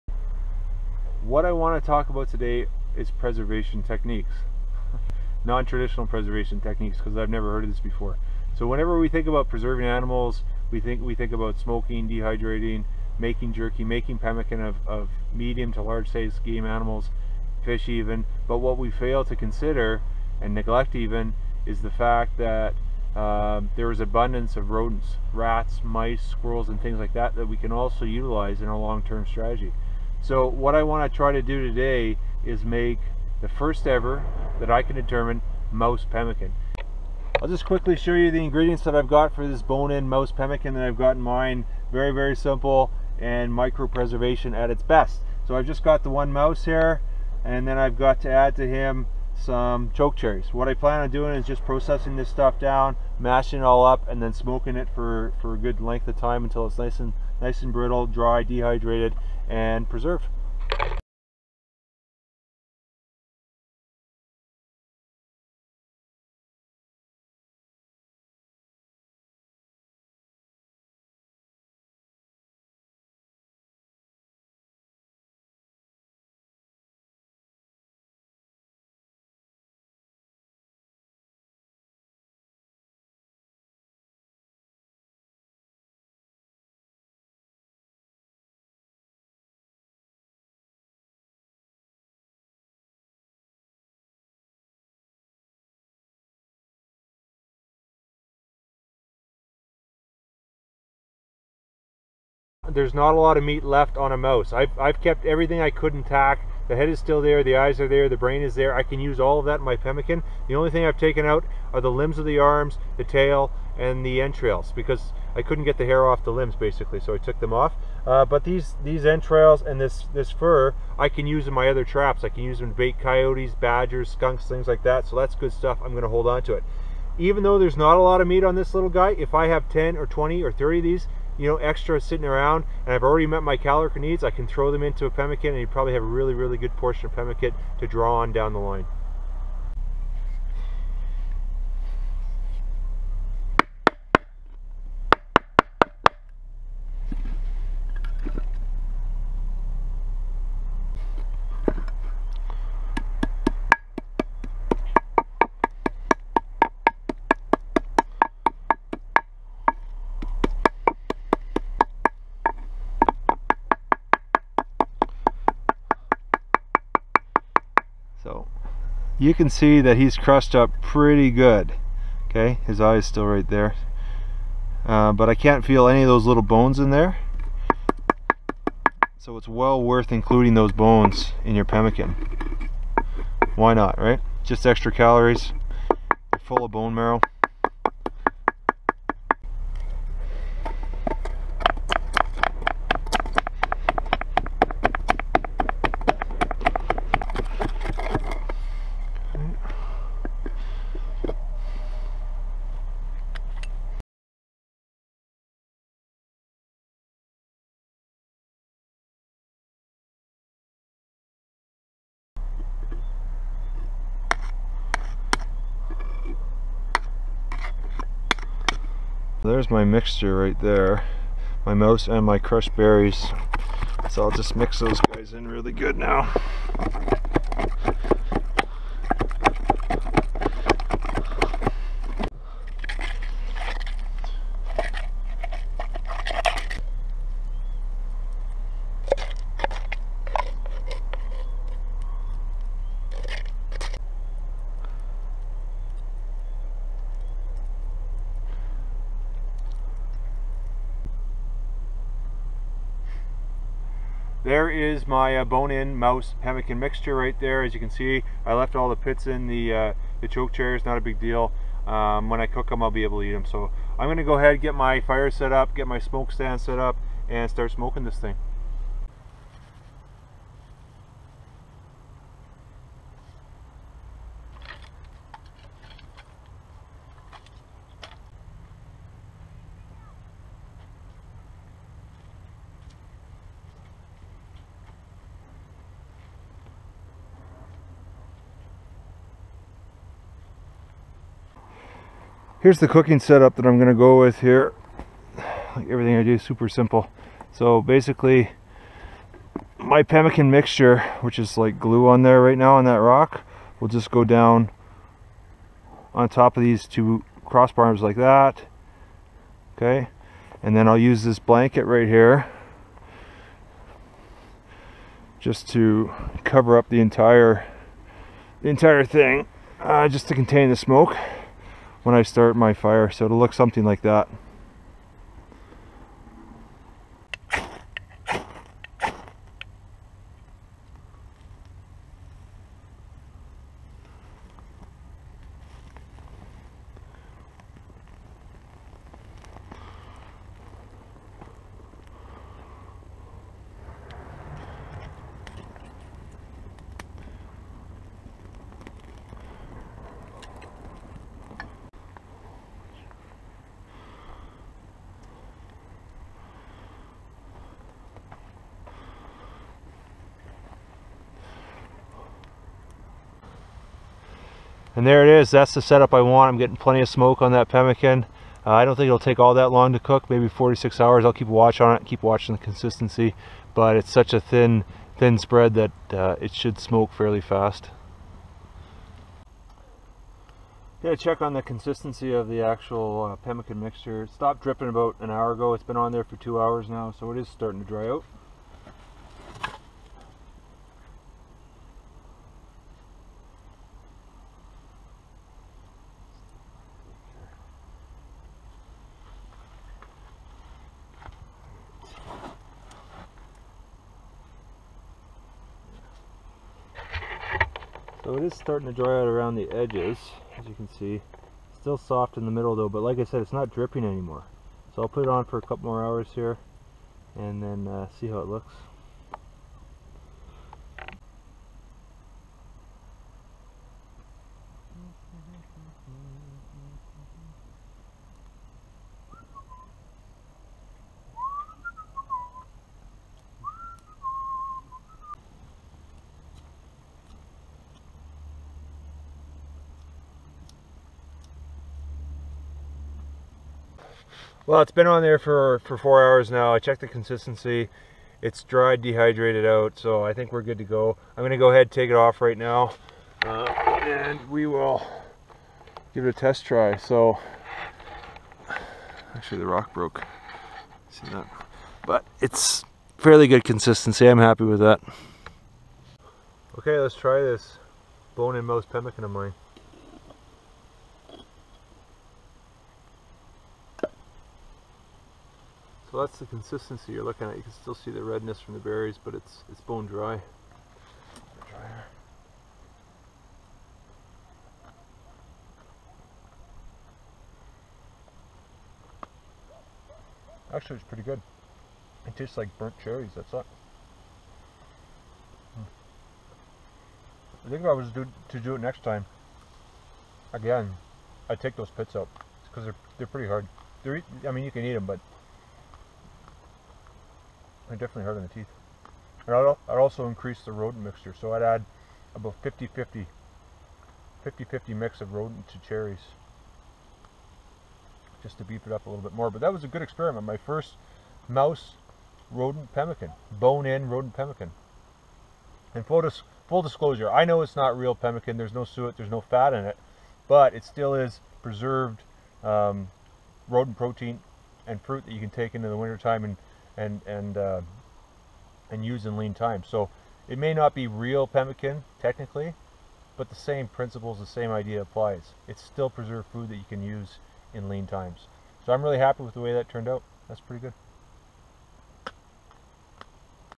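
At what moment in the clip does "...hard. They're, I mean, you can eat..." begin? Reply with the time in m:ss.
8:23.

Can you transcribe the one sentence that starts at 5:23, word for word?
So it'll look something like that.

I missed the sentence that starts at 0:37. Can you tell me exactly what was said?
I'll just quickly show you the ingredients that I've got for this bone-in mouse pemmican that I've got in mine.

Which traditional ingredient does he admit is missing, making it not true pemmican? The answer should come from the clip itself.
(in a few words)
Suet.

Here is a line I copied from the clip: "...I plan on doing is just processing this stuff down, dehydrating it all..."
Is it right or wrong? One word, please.
wrong.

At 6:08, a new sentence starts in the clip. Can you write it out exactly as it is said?
Uh, I don't think it'll take all that long to cook, maybe 46 hours.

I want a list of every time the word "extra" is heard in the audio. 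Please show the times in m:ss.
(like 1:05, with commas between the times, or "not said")
2:11, 3:04.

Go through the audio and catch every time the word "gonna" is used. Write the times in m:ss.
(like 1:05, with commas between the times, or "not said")
4:24, 6:21.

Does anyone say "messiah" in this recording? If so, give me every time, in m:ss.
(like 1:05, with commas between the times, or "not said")
not said.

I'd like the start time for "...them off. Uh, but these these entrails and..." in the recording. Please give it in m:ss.
1:57.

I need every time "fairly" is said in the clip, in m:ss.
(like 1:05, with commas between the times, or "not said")
6:17, 7:43.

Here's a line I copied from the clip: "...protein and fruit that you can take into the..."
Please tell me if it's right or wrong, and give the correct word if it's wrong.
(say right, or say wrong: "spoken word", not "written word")
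right.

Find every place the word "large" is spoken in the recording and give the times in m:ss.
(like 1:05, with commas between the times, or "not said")
0:15.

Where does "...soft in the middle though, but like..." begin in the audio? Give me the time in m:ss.
6:51.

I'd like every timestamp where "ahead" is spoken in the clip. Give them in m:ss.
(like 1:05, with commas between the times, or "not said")
4:24, 7:31.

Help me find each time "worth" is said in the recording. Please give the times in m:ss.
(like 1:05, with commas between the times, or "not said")
2:59.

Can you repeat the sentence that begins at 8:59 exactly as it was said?
So it may not be real pemmican technically, but the same principles, the same idea applies.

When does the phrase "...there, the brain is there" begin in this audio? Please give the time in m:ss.
1:47.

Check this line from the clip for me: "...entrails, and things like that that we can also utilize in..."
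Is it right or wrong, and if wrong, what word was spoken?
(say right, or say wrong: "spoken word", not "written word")
wrong: "squirrels", not "entrails".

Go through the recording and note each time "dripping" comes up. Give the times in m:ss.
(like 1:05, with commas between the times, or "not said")
6:24, 6:53.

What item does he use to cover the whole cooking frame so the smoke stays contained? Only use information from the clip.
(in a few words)
Blanket.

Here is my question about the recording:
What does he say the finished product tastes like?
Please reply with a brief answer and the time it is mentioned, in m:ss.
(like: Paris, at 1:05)
Burnt cherries, at 8:12.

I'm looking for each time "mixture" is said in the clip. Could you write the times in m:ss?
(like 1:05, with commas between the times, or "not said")
3:39, 4:16, 5:00, 6:23, 8:31.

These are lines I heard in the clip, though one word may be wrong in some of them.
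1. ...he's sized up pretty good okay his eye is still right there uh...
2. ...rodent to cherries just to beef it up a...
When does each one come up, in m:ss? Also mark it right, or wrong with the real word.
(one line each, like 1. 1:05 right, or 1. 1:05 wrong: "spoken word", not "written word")
1. 2:49 wrong: "crushed", not "sized"
2. 8:35 right.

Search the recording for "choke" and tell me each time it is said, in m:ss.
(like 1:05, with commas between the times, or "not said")
0:49, 4:20.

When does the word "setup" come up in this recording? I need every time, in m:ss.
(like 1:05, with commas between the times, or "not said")
4:53, 6:05.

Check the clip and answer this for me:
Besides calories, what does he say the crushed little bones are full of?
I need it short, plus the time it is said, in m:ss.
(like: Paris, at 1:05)
Bone marrow, at 3:06.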